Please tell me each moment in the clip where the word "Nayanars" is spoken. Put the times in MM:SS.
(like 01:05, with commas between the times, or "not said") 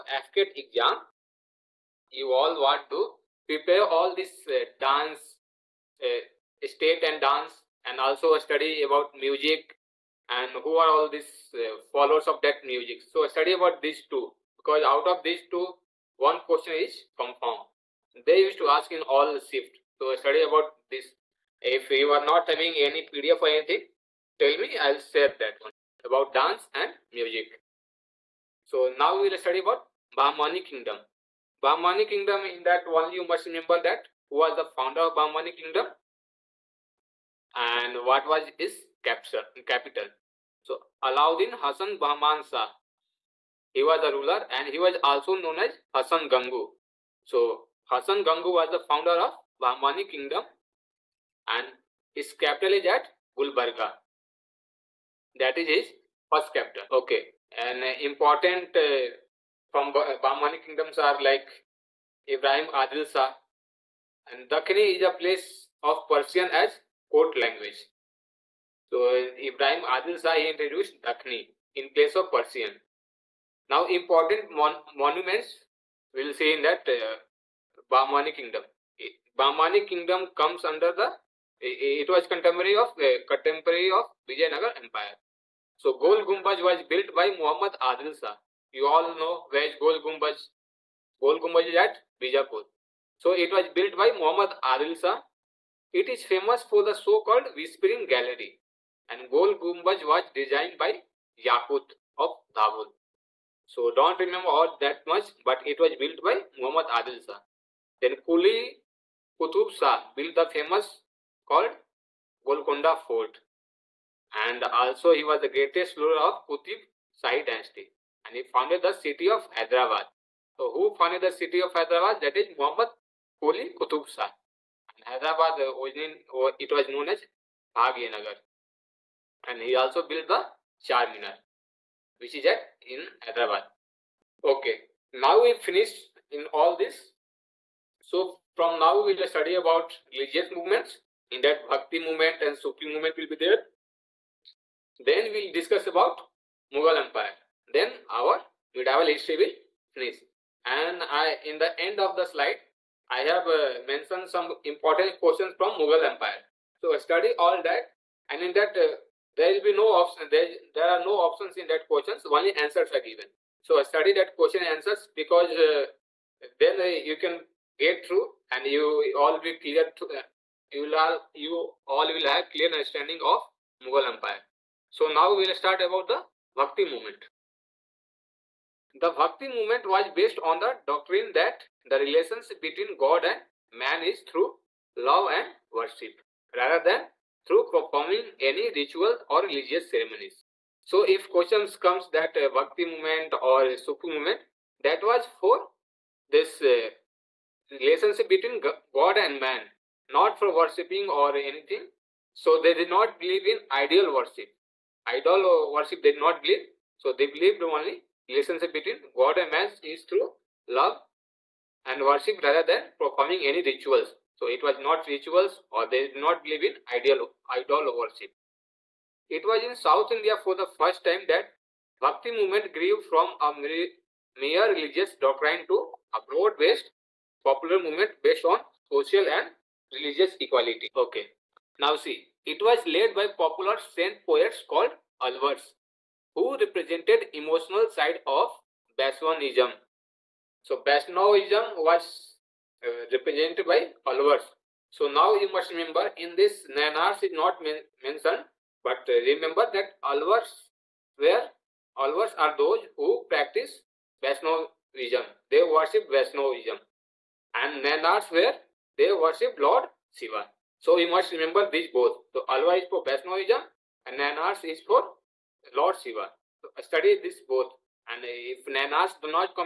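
04:06, 04:17.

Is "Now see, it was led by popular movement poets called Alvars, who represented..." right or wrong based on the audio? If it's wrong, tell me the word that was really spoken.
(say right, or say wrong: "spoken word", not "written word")
wrong: "saint", not "movement".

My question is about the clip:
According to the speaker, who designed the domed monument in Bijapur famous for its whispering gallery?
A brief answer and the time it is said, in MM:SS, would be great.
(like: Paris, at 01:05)
Yakut of Dabul, at 01:41.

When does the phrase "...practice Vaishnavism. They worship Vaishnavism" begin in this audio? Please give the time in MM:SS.
04:13.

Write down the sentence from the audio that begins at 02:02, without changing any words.
That is Muhammad Quli Qutub Shah.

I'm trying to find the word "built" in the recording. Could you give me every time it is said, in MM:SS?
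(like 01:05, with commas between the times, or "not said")
01:26, 01:33, 01:45, 01:50, 02:10.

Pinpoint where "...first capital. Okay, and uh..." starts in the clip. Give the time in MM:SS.
00:56.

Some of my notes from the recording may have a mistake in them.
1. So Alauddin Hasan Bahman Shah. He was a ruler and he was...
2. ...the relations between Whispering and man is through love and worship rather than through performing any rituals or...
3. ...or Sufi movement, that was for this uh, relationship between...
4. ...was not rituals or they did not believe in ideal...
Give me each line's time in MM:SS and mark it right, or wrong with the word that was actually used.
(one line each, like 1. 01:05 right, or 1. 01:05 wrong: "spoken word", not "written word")
1. 00:40 right
2. 03:01 wrong: "God", not "Whispering"
3. 03:13 right
4. 03:34 right.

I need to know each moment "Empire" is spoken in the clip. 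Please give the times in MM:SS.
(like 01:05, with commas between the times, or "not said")
01:24, 02:27, 02:36, 02:54.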